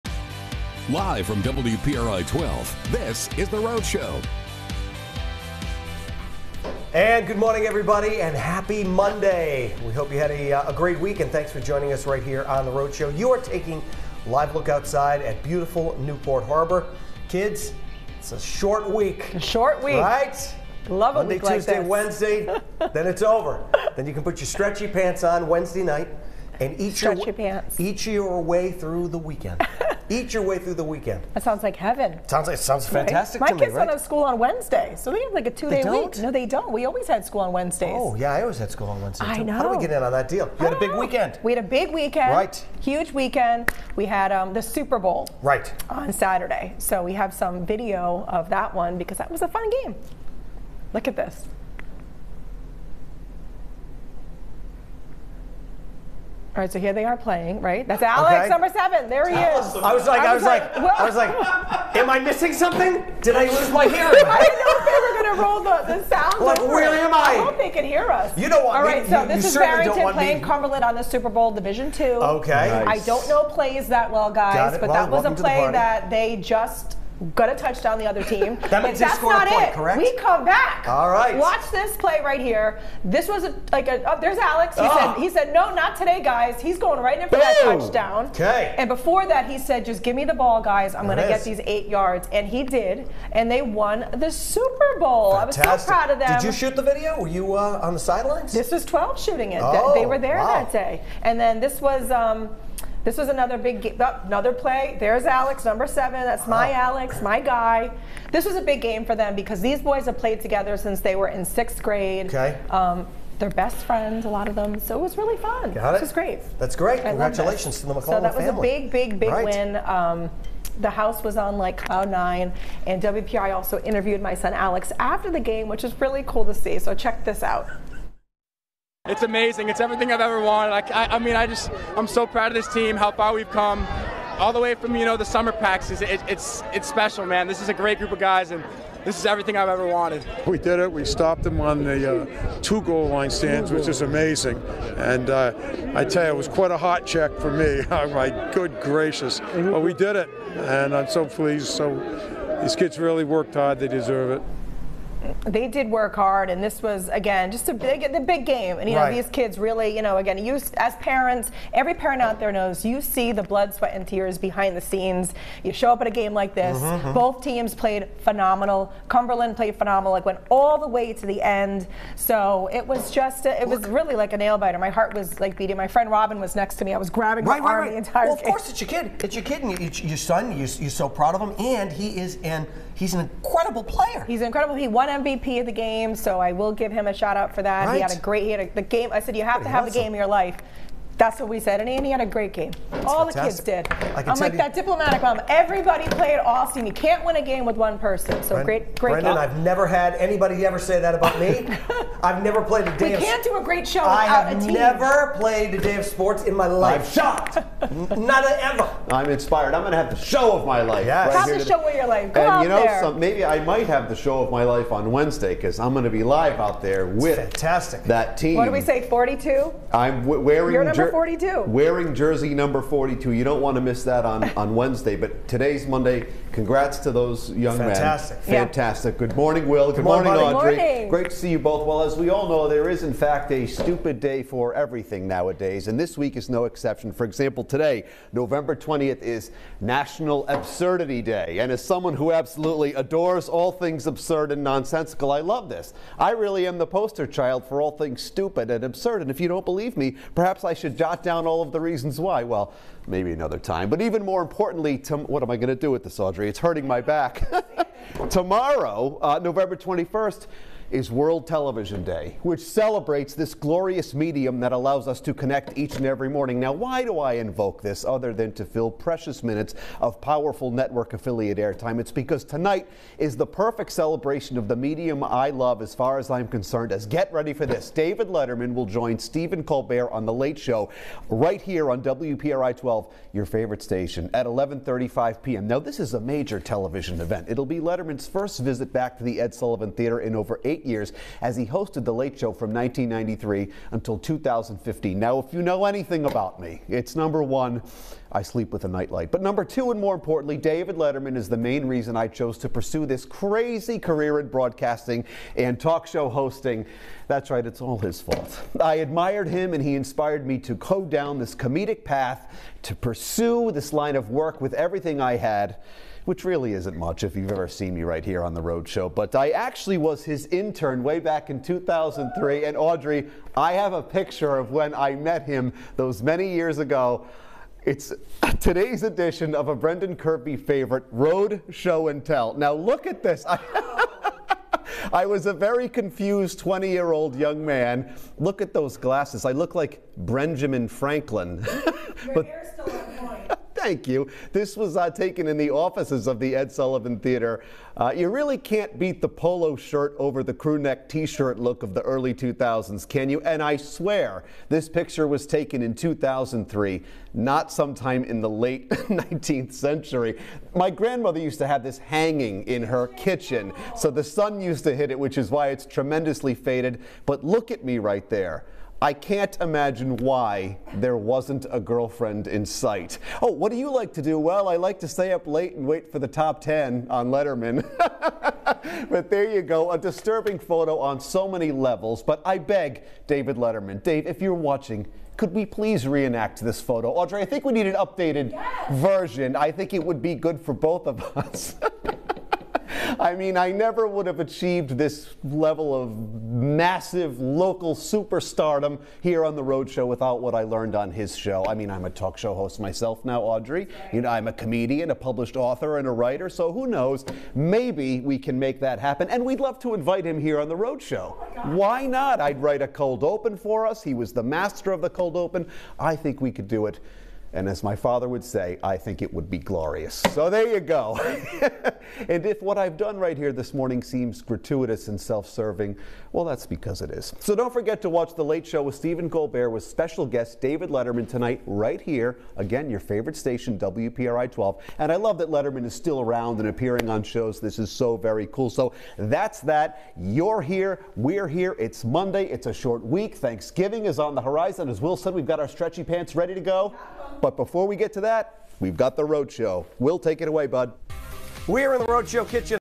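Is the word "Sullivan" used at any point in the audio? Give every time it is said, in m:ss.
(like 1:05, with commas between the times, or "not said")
4:49, 5:46.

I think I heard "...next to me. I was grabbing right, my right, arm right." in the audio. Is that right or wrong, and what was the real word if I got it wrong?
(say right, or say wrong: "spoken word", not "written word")
right.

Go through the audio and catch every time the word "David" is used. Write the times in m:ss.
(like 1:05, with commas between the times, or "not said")
4:37, 5:00, 6:23, 7:10.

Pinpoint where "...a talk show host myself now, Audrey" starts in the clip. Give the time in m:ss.
6:42.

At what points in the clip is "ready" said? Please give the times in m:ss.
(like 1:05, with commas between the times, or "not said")
4:37, 7:26.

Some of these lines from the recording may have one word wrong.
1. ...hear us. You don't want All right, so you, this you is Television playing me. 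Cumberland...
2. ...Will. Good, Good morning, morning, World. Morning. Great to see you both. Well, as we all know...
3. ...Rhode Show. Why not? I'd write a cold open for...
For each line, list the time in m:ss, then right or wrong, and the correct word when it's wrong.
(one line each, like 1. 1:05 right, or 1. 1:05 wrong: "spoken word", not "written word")
1. 1:07 wrong: "Barrington", not "Television"
2. 3:49 wrong: "Audrey", not "World"
3. 6:50 right.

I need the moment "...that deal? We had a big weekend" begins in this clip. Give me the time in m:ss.
0:40.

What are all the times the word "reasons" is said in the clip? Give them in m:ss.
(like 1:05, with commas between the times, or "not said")
4:11, 5:01.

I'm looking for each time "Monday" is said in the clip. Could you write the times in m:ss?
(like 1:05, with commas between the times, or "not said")
0:08, 0:21, 3:45, 7:22.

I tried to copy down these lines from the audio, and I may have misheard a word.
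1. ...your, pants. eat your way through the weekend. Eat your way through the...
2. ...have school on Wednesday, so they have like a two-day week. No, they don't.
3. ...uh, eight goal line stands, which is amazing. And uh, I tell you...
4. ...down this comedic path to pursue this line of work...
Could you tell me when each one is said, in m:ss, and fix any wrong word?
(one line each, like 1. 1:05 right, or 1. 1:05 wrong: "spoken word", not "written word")
1. 0:27 right
2. 0:33 right
3. 2:22 wrong: "two", not "eight"
4. 5:11 right.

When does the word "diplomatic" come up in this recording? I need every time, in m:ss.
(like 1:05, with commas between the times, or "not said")
3:14.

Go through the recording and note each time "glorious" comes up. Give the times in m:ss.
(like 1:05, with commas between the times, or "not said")
4:23, 6:59.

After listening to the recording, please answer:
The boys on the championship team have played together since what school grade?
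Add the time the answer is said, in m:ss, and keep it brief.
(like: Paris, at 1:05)
sixth grade, at 1:51.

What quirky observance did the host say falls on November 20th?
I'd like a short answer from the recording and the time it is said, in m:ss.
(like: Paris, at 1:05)
National Absurdity Day, at 3:59.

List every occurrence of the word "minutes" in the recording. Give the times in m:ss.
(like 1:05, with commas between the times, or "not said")
4:29.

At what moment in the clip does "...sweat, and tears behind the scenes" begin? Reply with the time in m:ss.
2:43.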